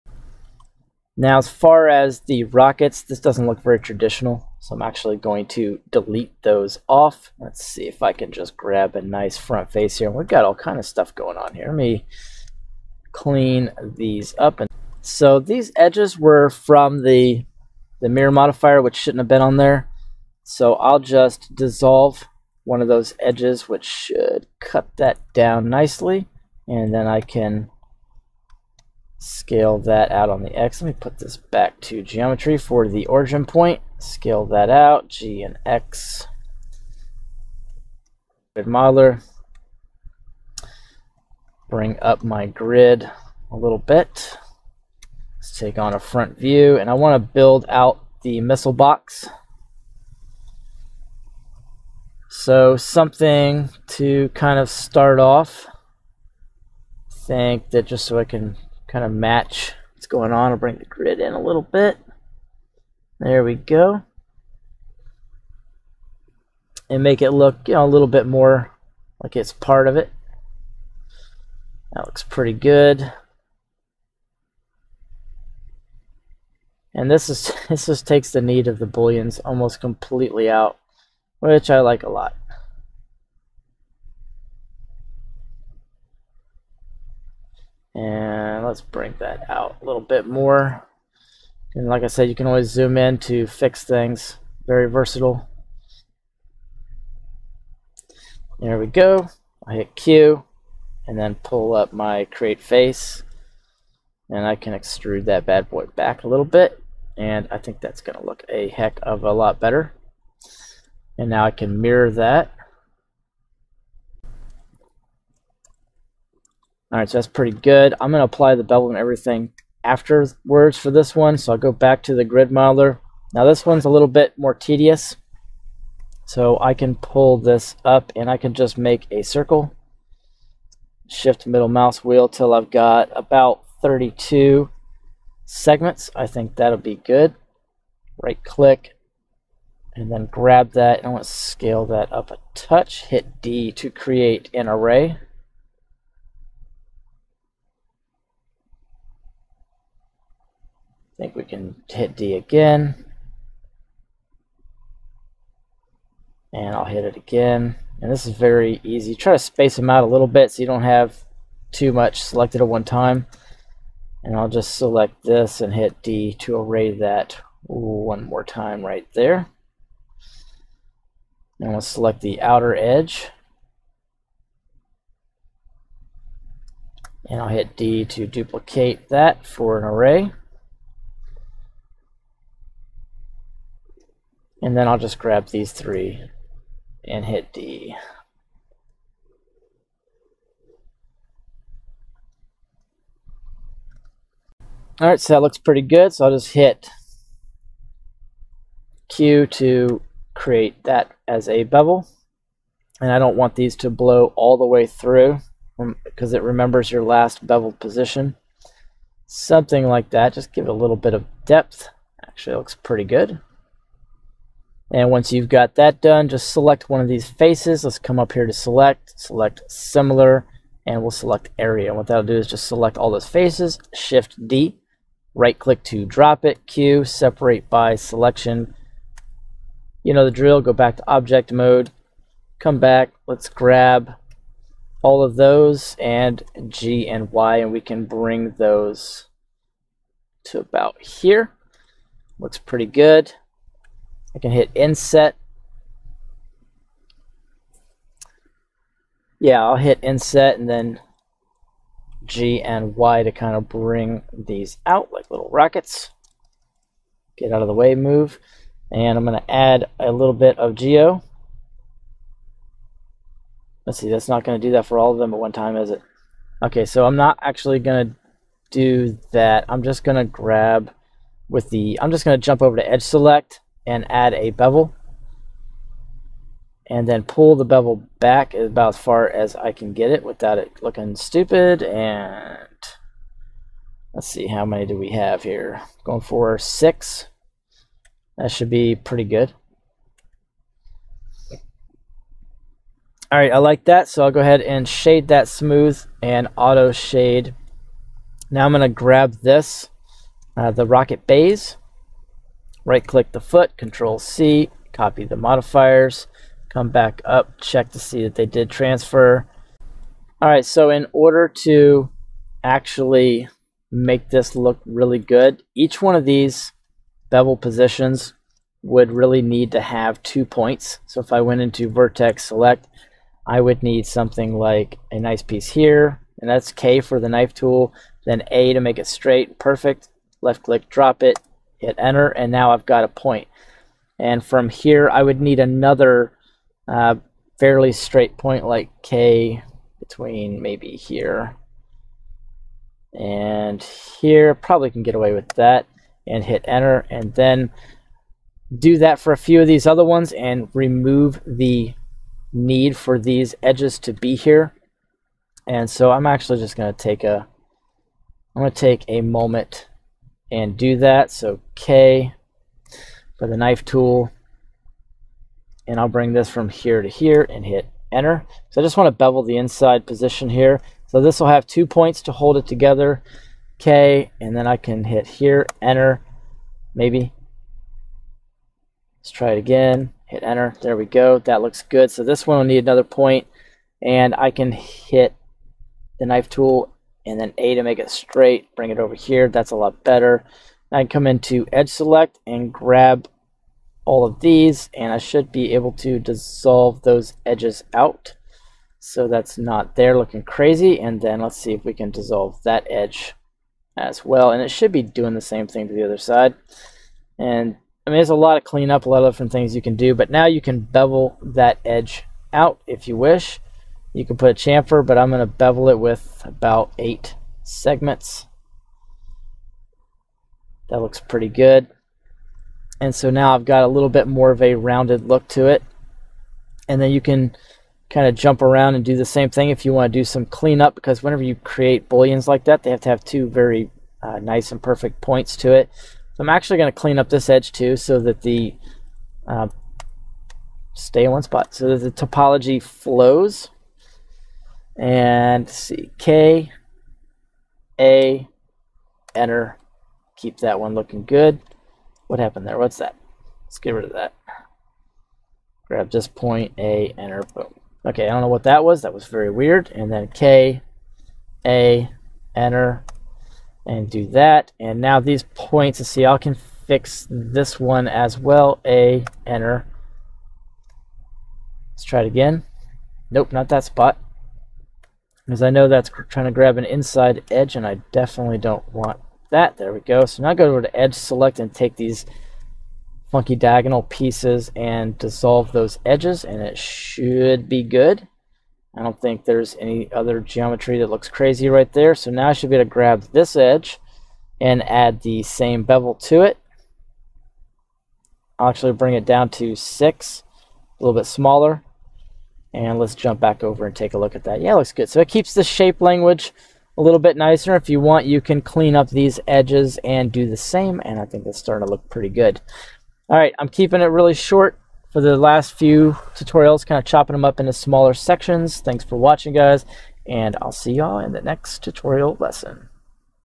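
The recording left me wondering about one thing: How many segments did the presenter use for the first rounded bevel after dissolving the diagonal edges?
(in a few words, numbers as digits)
8.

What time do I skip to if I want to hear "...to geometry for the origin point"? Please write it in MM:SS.
00:31.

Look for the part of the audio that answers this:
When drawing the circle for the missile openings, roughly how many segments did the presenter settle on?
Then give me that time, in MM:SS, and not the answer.
02:13.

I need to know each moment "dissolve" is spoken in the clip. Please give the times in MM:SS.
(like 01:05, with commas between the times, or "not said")
00:21, 06:36, 06:42, 08:05.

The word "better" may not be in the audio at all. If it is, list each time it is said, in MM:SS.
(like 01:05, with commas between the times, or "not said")
01:49, 06:30.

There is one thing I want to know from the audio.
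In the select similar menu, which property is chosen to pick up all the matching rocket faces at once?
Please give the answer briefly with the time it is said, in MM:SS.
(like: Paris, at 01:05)
Area, at 03:41.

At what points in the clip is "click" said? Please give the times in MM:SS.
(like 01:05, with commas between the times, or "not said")
02:18, 03:45, 05:03, 05:30.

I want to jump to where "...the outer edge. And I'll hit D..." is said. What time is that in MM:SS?
02:52.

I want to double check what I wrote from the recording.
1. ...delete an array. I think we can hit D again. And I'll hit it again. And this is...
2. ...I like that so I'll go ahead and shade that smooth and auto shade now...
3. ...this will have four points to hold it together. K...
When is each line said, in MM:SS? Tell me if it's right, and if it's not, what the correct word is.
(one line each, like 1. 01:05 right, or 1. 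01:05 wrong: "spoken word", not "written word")
1. 02:23 wrong: "create", not "delete"
2. 04:53 right
3. 06:11 wrong: "two", not "four".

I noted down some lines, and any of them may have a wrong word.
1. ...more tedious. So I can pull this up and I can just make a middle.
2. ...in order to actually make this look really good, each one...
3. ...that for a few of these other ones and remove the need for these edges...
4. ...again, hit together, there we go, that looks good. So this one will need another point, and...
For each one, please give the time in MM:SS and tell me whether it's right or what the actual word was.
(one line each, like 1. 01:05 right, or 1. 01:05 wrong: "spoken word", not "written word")
1. 02:04 wrong: "circle", not "middle"
2. 05:10 right
3. 05:48 right
4. 06:19 wrong: "enter", not "together".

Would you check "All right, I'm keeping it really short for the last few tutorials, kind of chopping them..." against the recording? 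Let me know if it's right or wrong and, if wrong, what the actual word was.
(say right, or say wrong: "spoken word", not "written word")
right.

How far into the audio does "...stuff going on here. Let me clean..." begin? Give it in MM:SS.
00:10.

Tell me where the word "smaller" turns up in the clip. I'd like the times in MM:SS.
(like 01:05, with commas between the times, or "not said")
08:21, 08:37.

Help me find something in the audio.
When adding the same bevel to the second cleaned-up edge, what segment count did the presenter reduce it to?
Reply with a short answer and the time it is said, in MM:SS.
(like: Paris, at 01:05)
6, at 08:19.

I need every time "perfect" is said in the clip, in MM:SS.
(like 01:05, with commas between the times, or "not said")
05:29, 07:14.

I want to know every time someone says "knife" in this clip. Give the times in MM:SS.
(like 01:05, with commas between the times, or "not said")
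05:27, 06:03, 06:26.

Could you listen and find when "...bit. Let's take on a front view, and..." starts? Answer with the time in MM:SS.
00:43.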